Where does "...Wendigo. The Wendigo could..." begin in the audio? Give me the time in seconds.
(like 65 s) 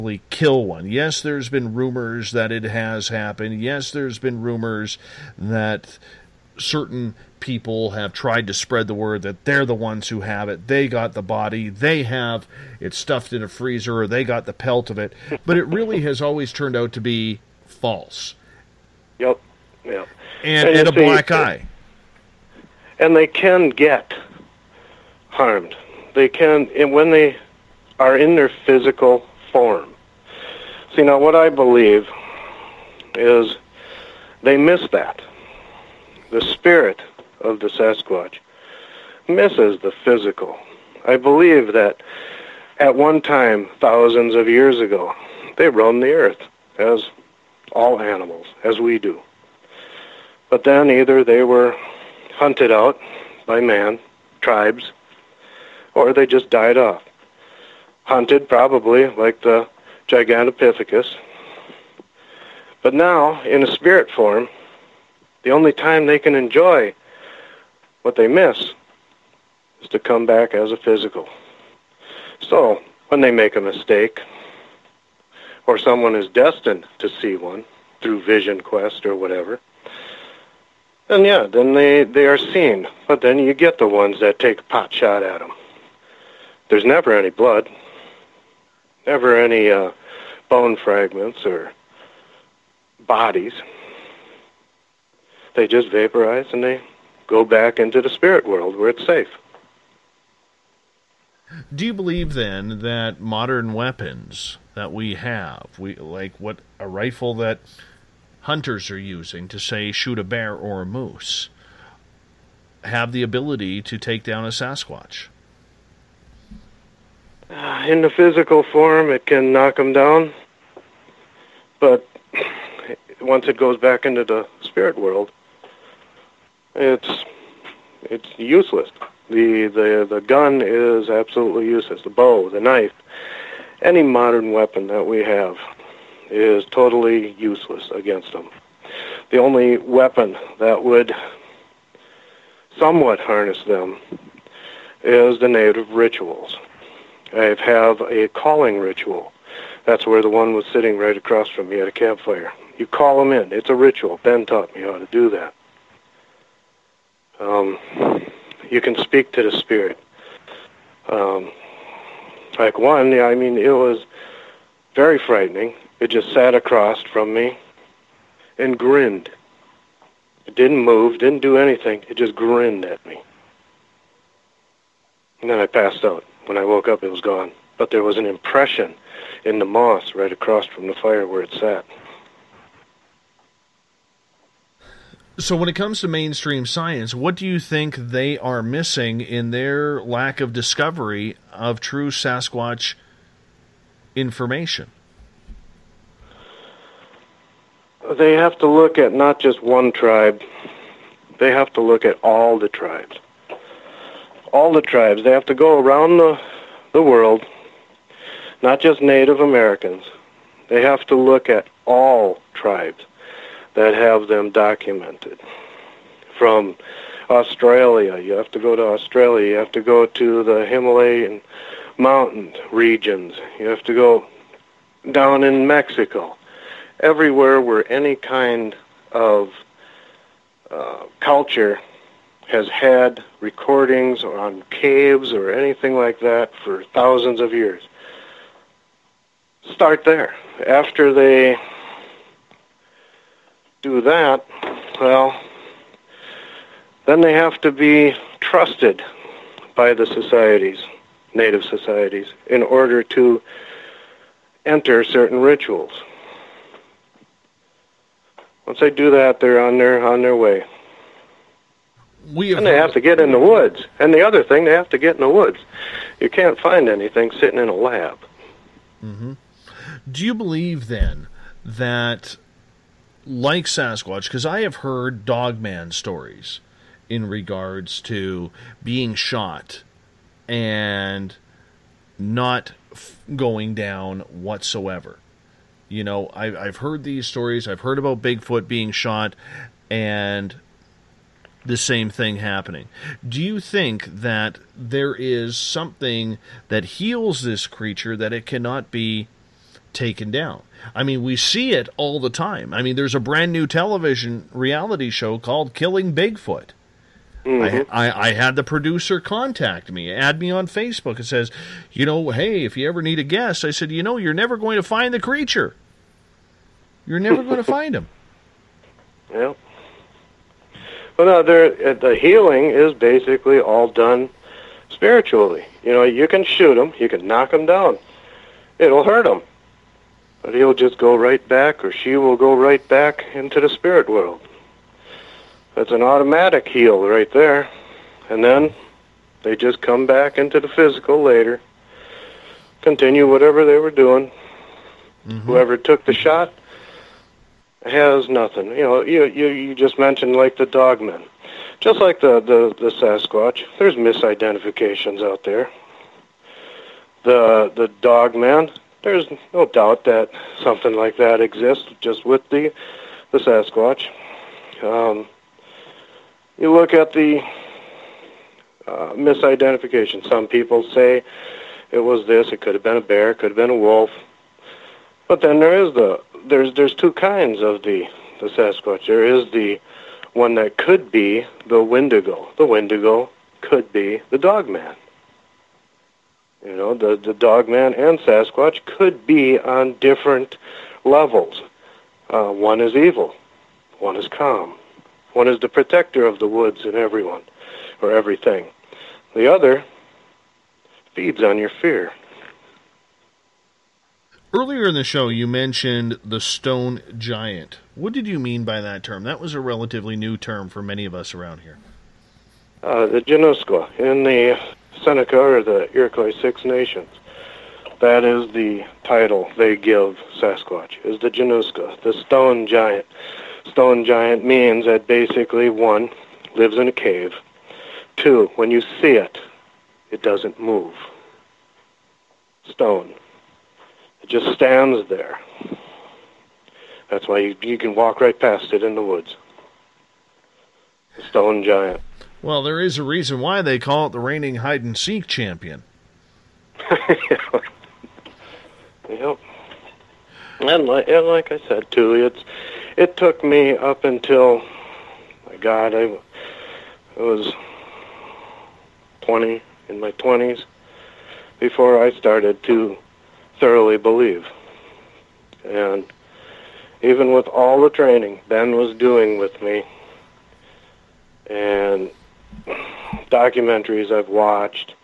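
381 s.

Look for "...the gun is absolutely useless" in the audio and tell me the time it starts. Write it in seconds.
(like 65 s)
130 s.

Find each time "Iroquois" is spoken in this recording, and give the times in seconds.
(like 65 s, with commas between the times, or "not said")
415 s.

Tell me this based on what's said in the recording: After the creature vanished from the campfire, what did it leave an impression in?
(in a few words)
Moss.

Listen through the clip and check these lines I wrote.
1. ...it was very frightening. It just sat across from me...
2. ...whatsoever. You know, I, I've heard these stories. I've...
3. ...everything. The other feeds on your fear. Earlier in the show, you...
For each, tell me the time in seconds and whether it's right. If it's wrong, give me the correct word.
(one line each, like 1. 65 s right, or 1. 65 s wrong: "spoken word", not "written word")
1. 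163 s right
2. 284 s right
3. 398 s right.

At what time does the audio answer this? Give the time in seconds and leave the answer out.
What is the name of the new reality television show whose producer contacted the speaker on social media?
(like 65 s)
305 s.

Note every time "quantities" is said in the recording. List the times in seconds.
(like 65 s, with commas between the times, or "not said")
not said.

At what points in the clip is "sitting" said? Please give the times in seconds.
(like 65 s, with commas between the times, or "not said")
150 s, 267 s.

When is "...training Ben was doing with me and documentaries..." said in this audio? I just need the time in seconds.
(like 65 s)
467 s.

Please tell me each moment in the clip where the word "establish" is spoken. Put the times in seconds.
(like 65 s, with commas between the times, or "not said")
not said.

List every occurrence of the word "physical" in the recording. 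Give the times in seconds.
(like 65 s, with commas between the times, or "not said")
28 s, 40 s, 70 s, 118 s, 340 s.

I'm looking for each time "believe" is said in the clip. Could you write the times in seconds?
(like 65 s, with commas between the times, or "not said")
31 s, 41 s, 101 s, 270 s, 463 s.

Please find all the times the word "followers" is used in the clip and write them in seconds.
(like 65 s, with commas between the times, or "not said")
not said.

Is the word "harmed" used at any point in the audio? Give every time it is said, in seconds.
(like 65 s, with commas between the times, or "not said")
25 s.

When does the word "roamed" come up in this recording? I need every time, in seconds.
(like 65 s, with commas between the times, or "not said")
45 s.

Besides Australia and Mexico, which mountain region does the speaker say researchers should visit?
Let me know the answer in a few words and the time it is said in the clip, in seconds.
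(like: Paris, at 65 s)
Himalayan mountain regions, at 220 s.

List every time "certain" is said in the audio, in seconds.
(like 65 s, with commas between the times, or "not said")
6 s, 255 s.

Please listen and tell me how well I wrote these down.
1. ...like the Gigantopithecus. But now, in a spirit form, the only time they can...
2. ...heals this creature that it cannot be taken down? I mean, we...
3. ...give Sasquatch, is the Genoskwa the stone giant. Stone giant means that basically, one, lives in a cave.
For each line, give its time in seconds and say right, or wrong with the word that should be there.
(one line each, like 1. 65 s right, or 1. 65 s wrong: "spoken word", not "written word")
1. 59 s right
2. 296 s right
3. 419 s right.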